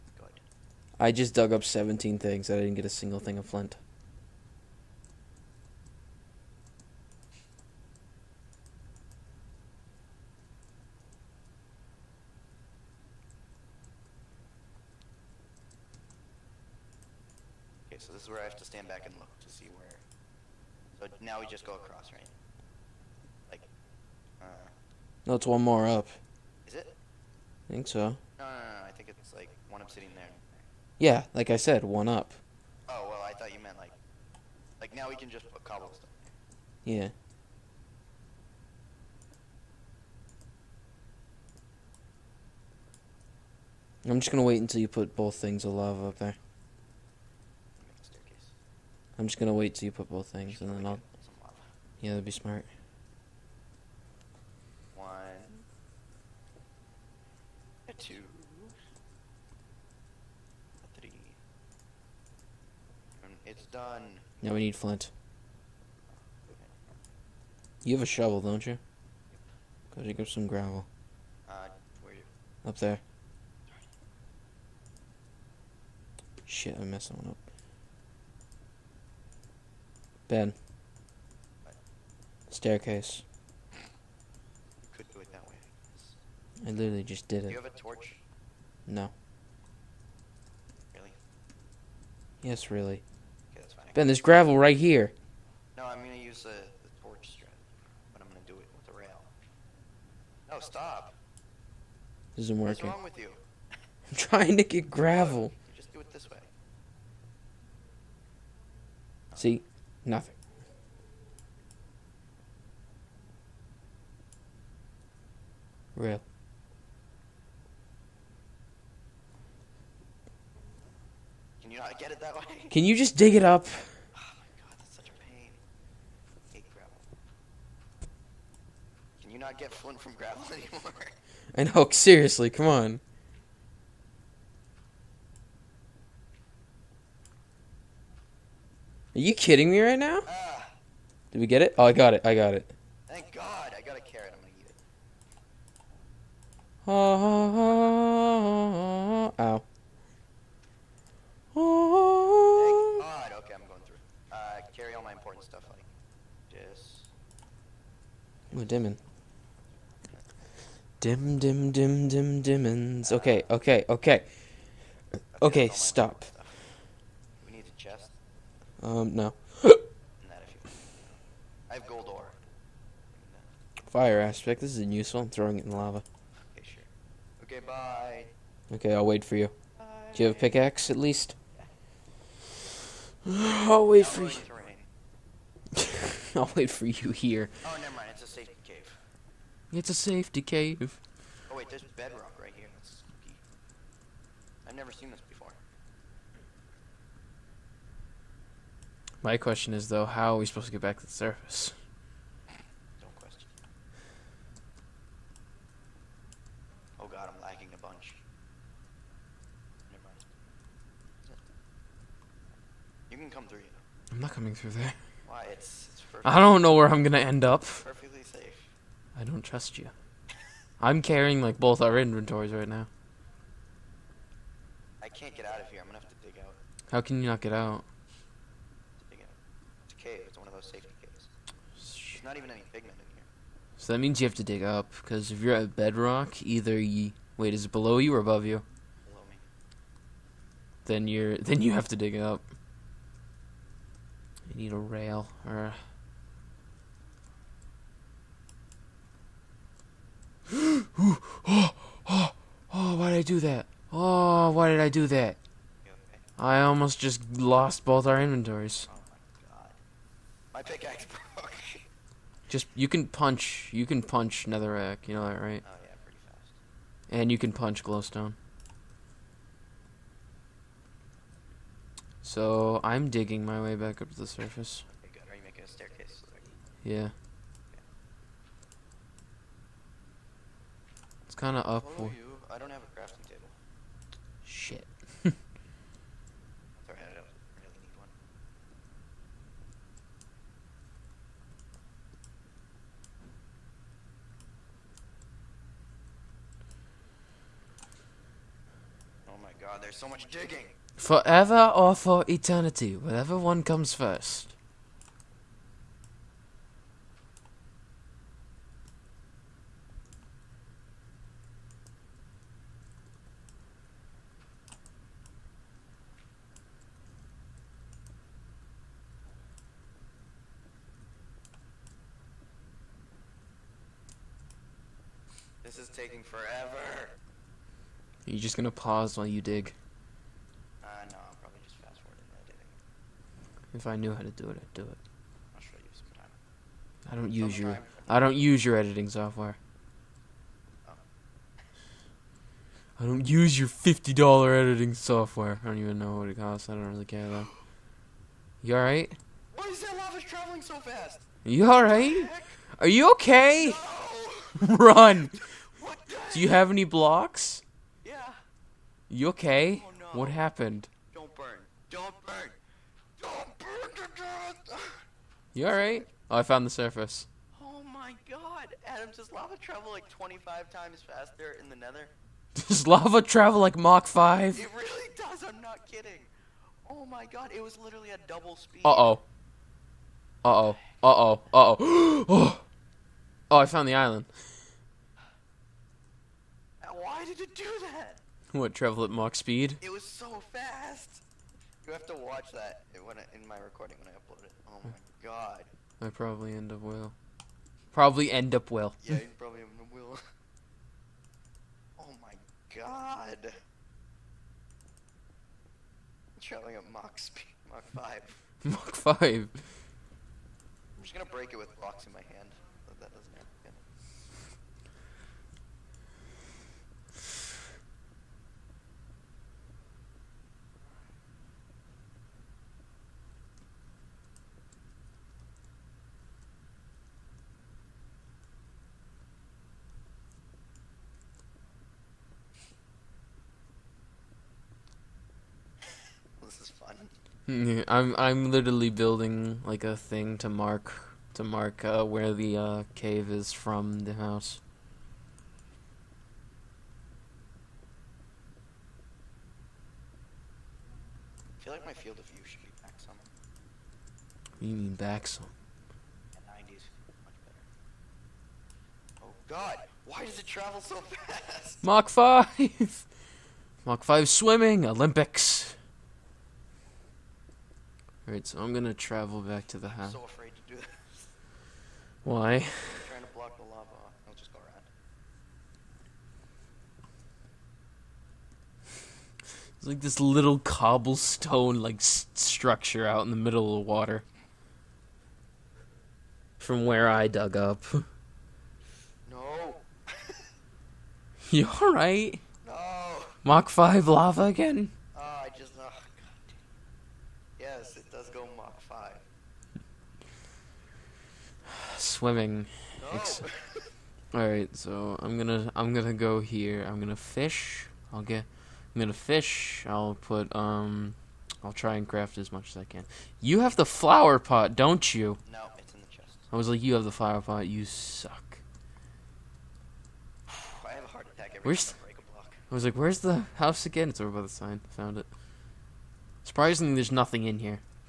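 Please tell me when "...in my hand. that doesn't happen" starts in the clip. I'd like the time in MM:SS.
06:52.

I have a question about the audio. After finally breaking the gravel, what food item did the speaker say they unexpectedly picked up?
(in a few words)
A carrot.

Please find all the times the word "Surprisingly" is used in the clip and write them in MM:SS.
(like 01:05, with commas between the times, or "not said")
08:46.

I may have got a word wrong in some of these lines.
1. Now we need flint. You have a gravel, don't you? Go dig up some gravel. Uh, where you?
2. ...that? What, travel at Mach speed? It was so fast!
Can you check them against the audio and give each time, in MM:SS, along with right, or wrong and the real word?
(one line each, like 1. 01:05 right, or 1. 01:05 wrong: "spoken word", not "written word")
1. 01:04 wrong: "shovel", not "gravel"
2. 06:27 right.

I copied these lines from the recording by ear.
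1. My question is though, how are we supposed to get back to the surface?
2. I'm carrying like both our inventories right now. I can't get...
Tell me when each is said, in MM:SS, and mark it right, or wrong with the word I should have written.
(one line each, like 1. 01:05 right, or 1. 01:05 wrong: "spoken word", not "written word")
1. 03:19 right
2. 03:40 right.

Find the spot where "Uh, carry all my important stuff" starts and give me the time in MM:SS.
02:34.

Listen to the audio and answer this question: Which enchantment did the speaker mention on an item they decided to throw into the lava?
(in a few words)
Fire aspect.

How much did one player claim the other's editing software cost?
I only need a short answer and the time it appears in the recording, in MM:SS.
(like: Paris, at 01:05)
50 dollars, at 05:43.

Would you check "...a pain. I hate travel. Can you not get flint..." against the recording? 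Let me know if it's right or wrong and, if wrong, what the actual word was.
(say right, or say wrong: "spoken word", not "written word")
wrong: "gravel", not "travel".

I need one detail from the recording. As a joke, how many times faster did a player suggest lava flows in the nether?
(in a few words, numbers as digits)
25.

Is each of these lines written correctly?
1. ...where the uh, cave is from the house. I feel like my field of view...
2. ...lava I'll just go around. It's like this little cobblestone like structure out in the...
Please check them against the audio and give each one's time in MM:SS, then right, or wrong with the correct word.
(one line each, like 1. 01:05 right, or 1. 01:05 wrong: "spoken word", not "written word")
1. 07:22 right
2. 07:53 right.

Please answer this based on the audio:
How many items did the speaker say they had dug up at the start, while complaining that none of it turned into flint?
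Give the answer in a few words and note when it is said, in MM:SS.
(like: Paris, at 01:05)
17, at 00:01.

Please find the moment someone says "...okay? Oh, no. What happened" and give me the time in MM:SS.
05:59.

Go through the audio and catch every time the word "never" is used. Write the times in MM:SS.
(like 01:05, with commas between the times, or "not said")
03:07, 03:14.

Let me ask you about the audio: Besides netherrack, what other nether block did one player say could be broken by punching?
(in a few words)
Glowstone.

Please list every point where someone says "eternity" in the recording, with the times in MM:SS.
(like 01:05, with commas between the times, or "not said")
05:02.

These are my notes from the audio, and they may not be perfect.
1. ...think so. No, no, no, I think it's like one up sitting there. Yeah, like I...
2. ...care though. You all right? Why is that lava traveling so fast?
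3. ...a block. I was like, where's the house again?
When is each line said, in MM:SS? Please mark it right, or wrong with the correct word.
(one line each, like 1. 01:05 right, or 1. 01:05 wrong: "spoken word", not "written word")
1. 00:27 right
2. 05:47 right
3. 08:42 right.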